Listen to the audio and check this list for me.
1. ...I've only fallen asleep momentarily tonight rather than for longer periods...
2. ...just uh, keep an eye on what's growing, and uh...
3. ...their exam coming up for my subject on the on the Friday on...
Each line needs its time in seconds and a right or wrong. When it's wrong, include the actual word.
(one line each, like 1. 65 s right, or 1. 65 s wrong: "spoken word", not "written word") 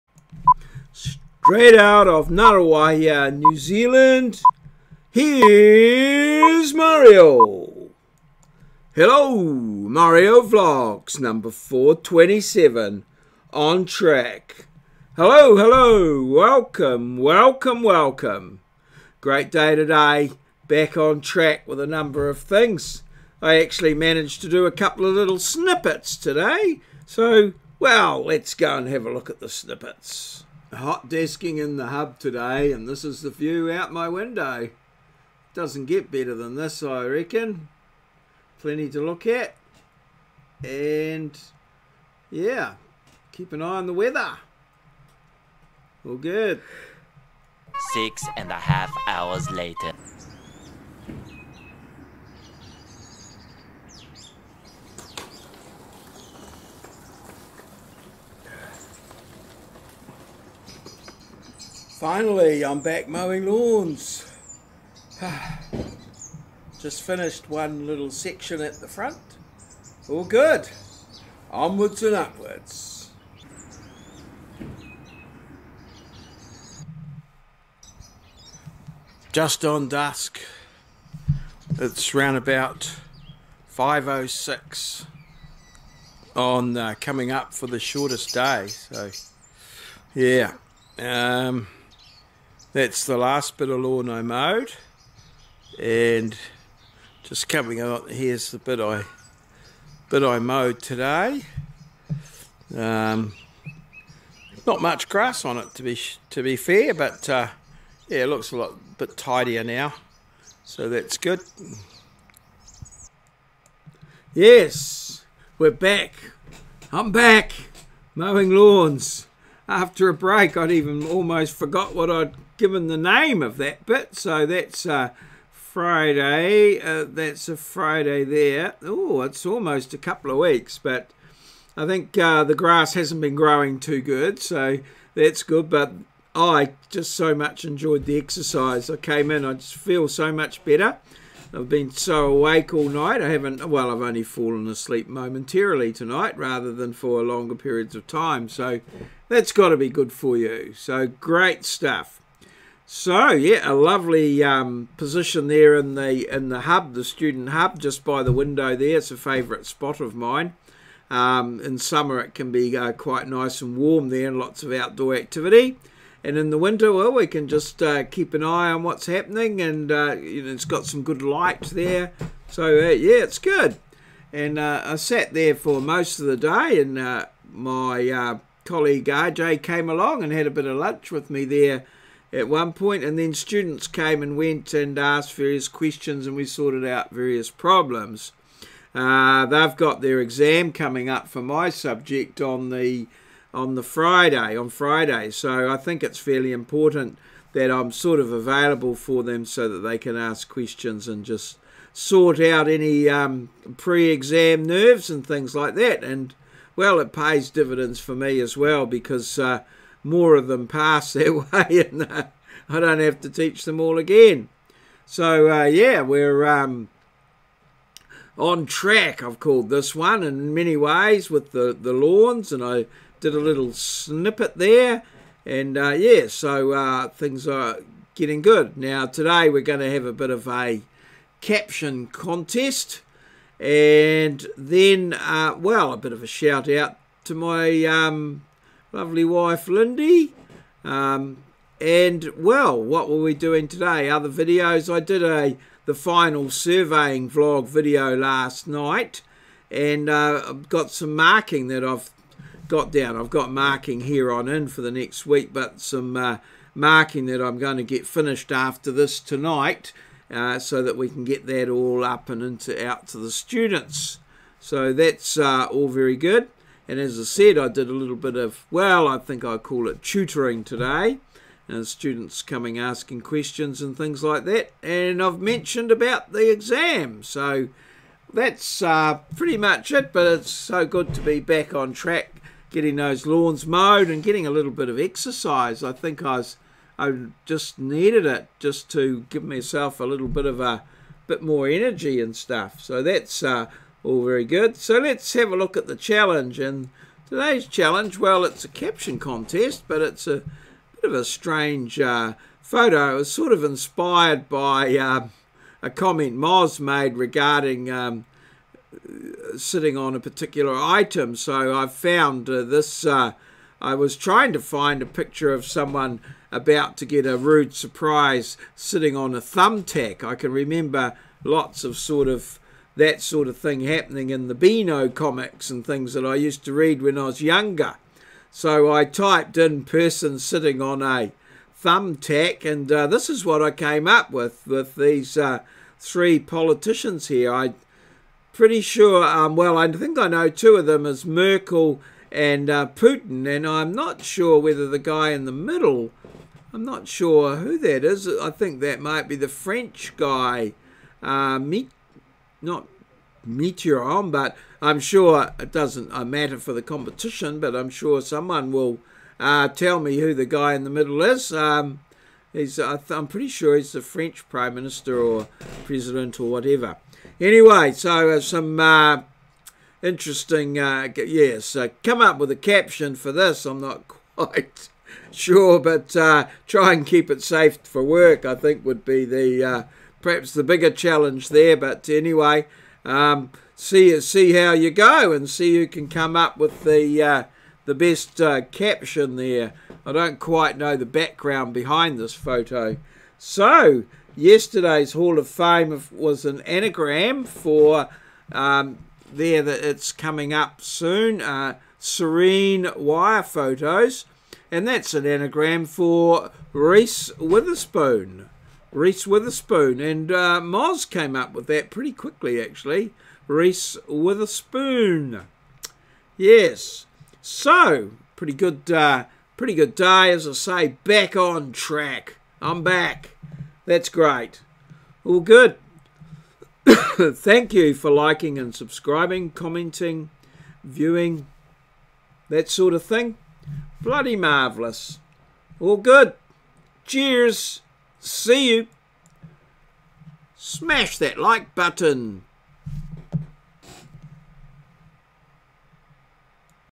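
1. 143 s right
2. 167 s wrong: "happening", not "growing"
3. 190 s right.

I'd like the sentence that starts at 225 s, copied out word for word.
And uh, yeah, so uh, things are getting good.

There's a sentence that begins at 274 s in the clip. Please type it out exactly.
And I've mentioned about the exam.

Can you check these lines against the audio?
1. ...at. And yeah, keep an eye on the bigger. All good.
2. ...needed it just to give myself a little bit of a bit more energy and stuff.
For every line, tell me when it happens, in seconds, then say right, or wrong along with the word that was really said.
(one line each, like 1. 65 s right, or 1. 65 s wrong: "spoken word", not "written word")
1. 39 s wrong: "weather", not "bigger"
2. 287 s right.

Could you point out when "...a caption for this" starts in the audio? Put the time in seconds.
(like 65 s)
372 s.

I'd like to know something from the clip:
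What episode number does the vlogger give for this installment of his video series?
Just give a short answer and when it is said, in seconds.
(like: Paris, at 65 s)
427, at 11 s.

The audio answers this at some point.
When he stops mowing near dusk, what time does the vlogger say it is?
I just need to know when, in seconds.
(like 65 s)
83 s.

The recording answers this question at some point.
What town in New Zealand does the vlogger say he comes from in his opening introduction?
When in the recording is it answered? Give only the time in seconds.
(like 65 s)
2 s.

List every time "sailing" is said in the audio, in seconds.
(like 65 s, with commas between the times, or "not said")
not said.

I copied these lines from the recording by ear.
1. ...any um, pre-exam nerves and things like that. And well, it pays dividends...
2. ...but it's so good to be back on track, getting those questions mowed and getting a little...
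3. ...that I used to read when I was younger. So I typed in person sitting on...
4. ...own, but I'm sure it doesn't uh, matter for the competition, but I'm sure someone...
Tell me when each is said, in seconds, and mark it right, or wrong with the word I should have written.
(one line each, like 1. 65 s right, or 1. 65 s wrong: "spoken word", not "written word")
1. 202 s right
2. 280 s wrong: "lawns", not "questions"
3. 326 s right
4. 354 s right.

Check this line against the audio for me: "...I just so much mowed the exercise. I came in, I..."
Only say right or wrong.
wrong.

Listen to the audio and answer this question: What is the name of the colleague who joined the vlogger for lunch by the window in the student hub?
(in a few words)
RJ.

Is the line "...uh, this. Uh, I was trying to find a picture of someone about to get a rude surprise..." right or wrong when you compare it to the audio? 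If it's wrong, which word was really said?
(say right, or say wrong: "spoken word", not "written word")
right.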